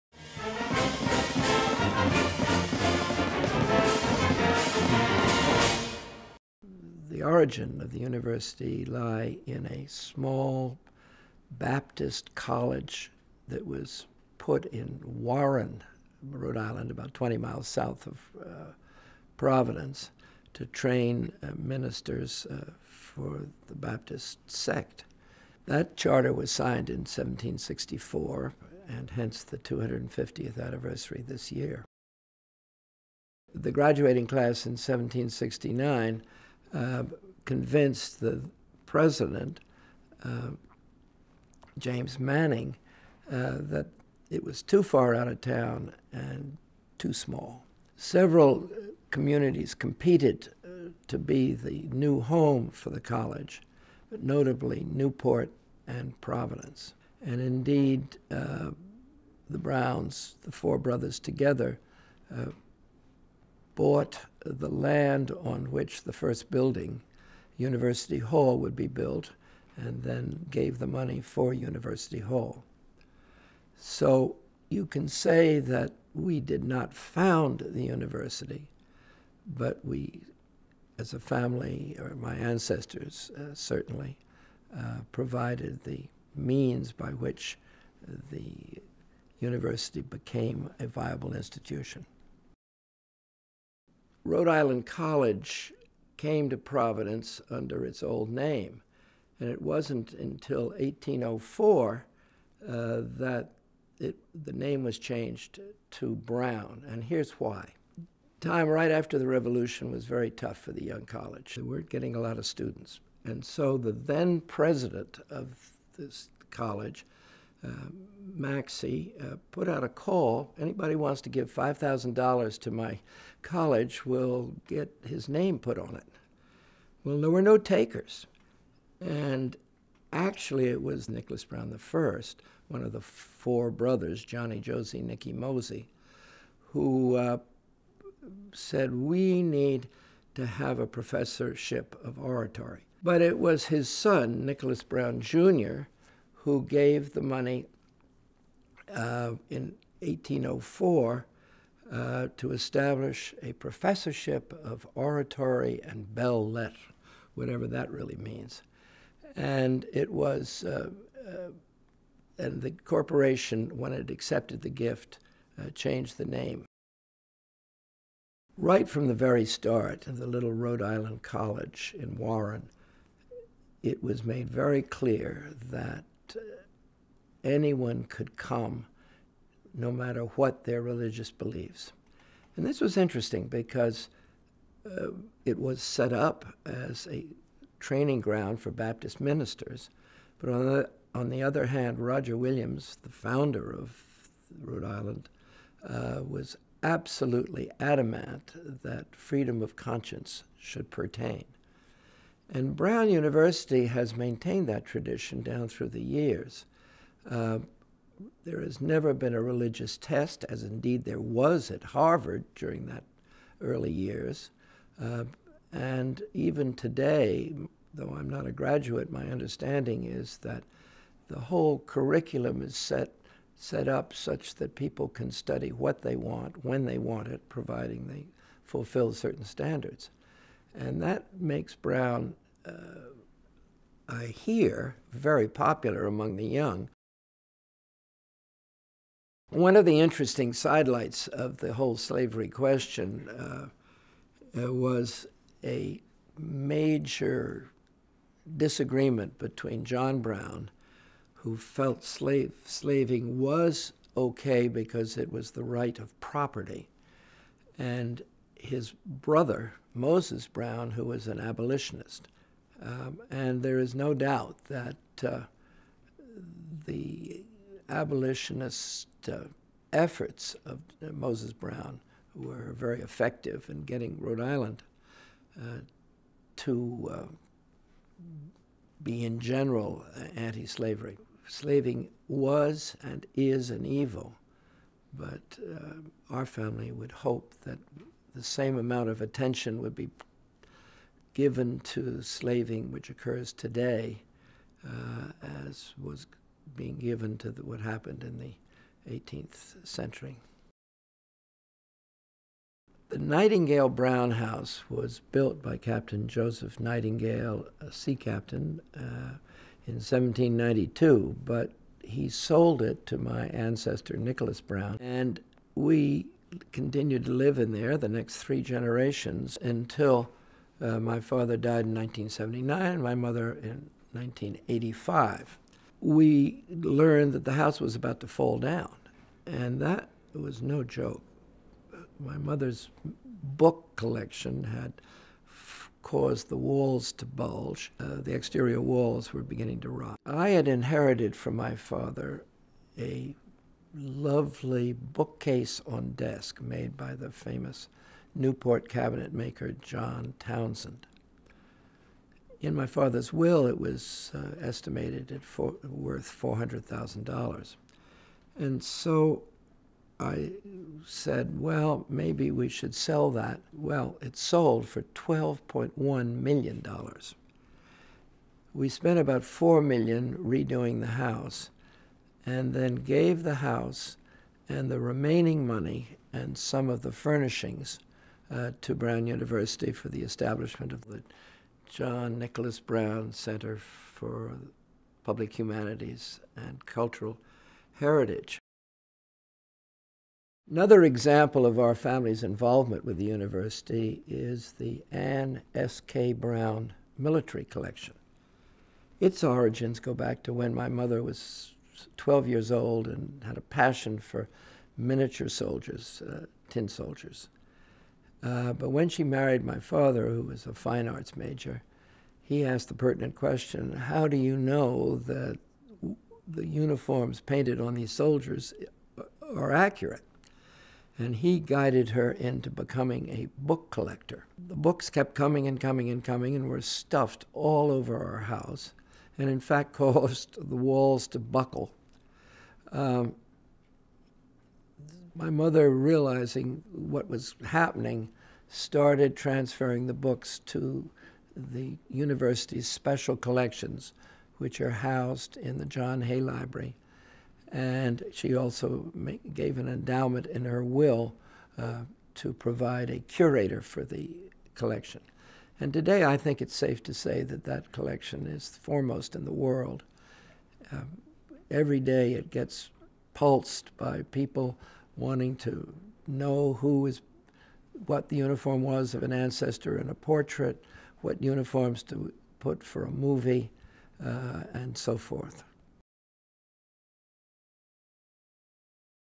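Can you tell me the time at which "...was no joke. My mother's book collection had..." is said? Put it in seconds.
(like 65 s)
330 s.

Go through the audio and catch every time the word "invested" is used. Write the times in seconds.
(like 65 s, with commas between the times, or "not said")
not said.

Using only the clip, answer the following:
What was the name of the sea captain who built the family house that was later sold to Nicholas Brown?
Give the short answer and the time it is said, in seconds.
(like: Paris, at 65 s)
Joseph Nightingale, at 305 s.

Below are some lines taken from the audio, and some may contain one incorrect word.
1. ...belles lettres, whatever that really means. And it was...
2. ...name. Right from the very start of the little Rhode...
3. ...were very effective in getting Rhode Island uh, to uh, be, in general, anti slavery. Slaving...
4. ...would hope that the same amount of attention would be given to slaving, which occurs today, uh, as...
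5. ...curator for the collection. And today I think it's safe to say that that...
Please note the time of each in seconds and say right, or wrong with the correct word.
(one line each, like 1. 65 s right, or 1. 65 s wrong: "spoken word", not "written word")
1. 156 s right
2. 166 s right
3. 272 s right
4. 286 s right
5. 453 s right.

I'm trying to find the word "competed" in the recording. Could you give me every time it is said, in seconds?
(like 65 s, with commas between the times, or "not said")
49 s.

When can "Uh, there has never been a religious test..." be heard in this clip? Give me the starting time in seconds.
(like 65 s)
207 s.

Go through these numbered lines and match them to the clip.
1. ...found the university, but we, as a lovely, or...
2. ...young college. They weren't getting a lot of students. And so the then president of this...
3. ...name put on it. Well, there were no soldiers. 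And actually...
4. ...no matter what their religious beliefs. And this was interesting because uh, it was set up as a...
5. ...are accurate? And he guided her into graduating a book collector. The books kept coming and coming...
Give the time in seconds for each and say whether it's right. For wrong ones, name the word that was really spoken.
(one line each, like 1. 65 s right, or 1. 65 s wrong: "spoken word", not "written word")
1. 76 s wrong: "family", not "lovely"
2. 110 s right
3. 125 s wrong: "takers", not "soldiers"
4. 179 s right
5. 419 s wrong: "becoming", not "graduating".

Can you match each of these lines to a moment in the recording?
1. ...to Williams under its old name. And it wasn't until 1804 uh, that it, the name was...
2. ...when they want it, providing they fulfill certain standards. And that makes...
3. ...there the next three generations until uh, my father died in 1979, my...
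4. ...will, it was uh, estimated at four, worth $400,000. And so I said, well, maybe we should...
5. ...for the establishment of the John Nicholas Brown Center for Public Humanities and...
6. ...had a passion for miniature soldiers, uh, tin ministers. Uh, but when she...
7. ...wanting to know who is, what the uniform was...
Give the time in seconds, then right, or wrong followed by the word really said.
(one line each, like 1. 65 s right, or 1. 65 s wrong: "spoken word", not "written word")
1. 96 s wrong: "Providence", not "Williams"
2. 226 s right
3. 317 s right
4. 353 s right
5. 379 s right
6. 403 s wrong: "soldiers", not "ministers"
7. 465 s right.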